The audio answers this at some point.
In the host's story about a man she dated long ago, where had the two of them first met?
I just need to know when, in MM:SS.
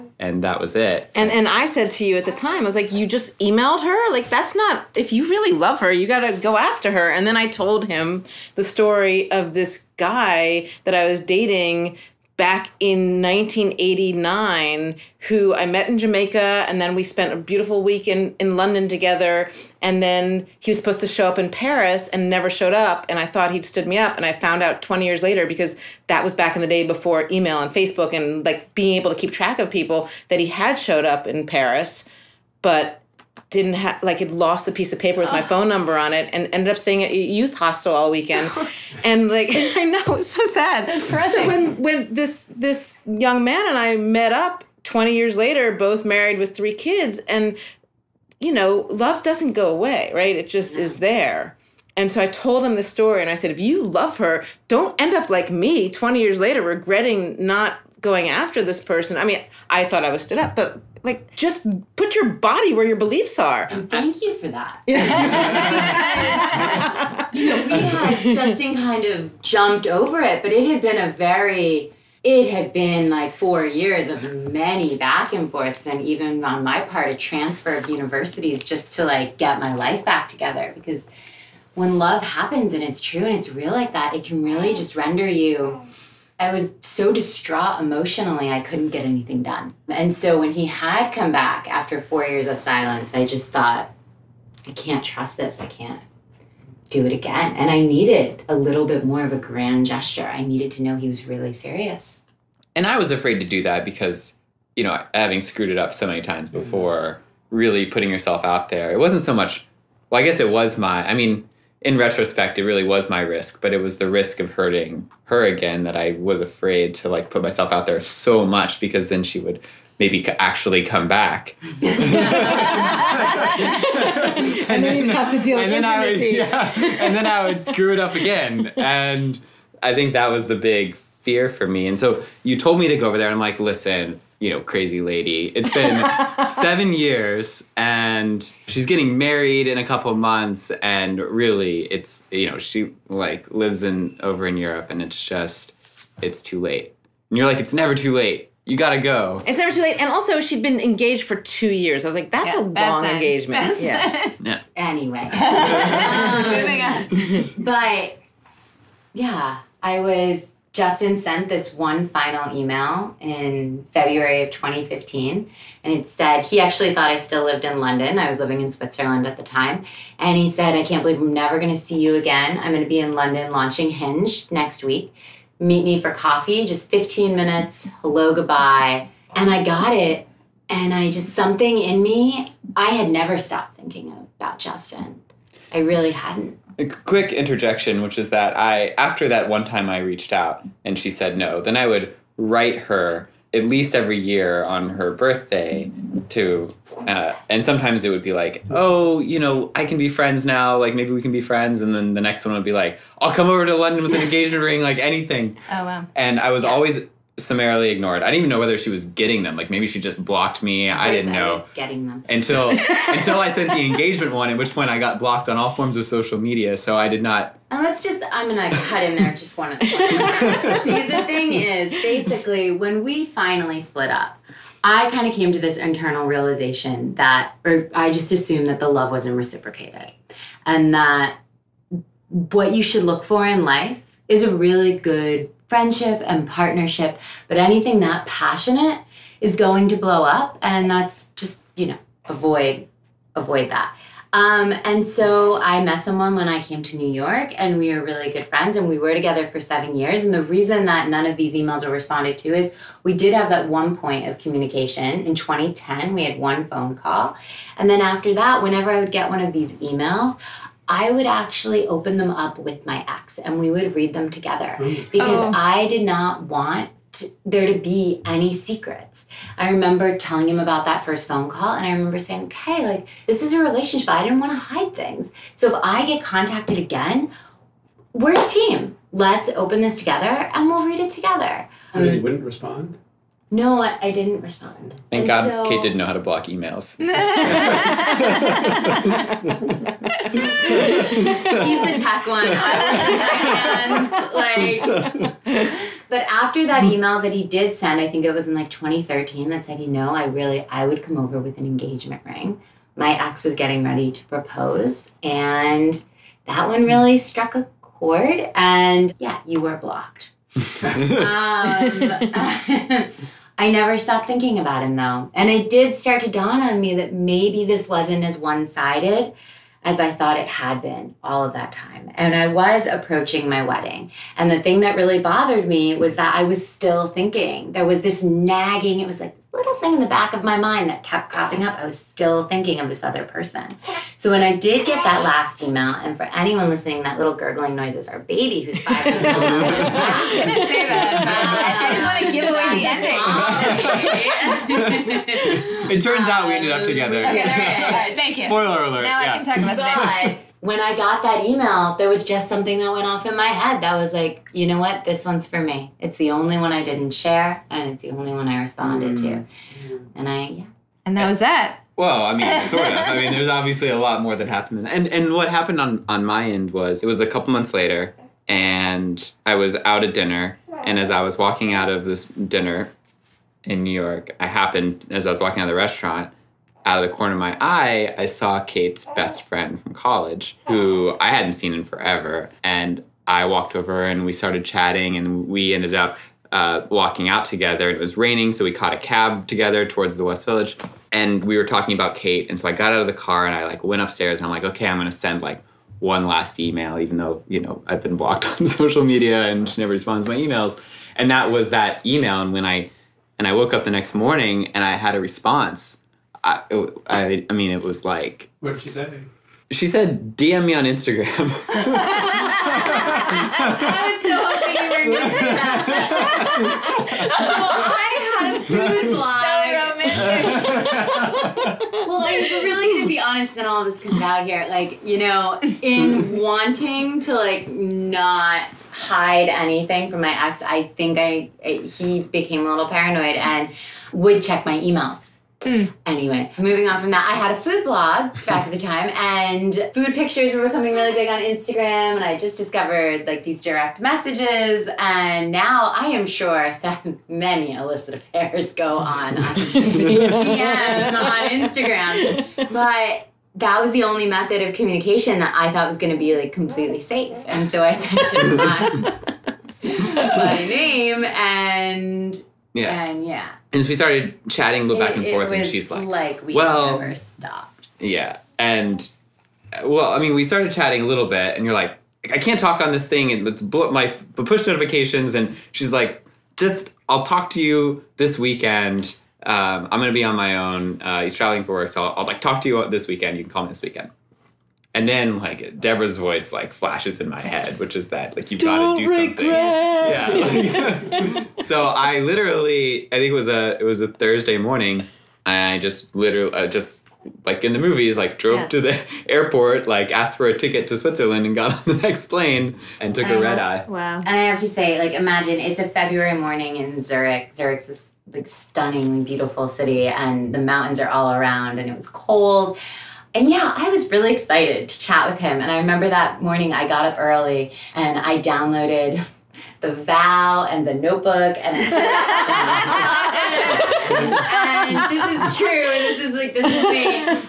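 00:15.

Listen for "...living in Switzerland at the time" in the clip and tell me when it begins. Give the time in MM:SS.
02:48.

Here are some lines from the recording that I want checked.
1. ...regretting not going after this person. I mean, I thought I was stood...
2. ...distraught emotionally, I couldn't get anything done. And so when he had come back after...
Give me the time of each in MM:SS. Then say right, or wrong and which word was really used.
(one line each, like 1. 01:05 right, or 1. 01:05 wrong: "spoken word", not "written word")
1. 00:56 right
2. 01:27 right.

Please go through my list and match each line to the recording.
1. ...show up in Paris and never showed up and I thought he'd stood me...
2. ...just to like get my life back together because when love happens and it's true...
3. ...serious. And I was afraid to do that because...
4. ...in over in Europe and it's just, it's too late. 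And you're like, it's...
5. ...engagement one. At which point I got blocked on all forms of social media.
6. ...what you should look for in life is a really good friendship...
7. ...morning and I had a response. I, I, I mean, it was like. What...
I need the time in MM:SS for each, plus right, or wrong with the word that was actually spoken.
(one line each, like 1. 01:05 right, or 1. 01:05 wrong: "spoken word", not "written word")
1. 00:21 right
2. 01:18 right
3. 01:41 right
4. 02:23 right
5. 03:33 right
6. 03:52 right
7. 06:44 right.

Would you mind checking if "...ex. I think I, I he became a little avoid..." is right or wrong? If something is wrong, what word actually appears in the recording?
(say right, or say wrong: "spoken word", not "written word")
wrong: "paranoid", not "avoid".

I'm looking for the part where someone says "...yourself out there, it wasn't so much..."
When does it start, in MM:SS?
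01:48.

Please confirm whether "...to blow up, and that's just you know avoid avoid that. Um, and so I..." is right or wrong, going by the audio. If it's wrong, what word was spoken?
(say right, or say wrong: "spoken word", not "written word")
right.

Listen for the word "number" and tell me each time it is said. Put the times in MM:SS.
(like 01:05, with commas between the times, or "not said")
00:35.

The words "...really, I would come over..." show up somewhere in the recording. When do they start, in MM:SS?
05:00.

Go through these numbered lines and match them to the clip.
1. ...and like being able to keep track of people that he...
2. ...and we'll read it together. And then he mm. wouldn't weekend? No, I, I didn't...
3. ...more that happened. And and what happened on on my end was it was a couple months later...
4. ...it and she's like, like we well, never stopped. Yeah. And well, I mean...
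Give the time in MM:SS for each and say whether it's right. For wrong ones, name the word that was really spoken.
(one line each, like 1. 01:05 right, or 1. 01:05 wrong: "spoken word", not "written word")
1. 00:28 right
2. 04:40 wrong: "respond", not "weekend"
3. 06:04 right
4. 07:45 right.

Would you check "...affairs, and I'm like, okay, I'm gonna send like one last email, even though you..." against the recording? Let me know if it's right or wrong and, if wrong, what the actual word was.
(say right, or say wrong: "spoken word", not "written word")
wrong: "upstairs", not "affairs".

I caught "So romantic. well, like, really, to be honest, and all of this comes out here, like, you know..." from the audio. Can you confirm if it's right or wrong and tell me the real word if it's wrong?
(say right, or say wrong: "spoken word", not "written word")
right.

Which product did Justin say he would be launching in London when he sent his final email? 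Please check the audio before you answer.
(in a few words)
Hinge.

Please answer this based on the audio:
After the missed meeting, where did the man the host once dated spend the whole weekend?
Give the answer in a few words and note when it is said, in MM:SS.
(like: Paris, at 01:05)
a youth hostel, at 00:37.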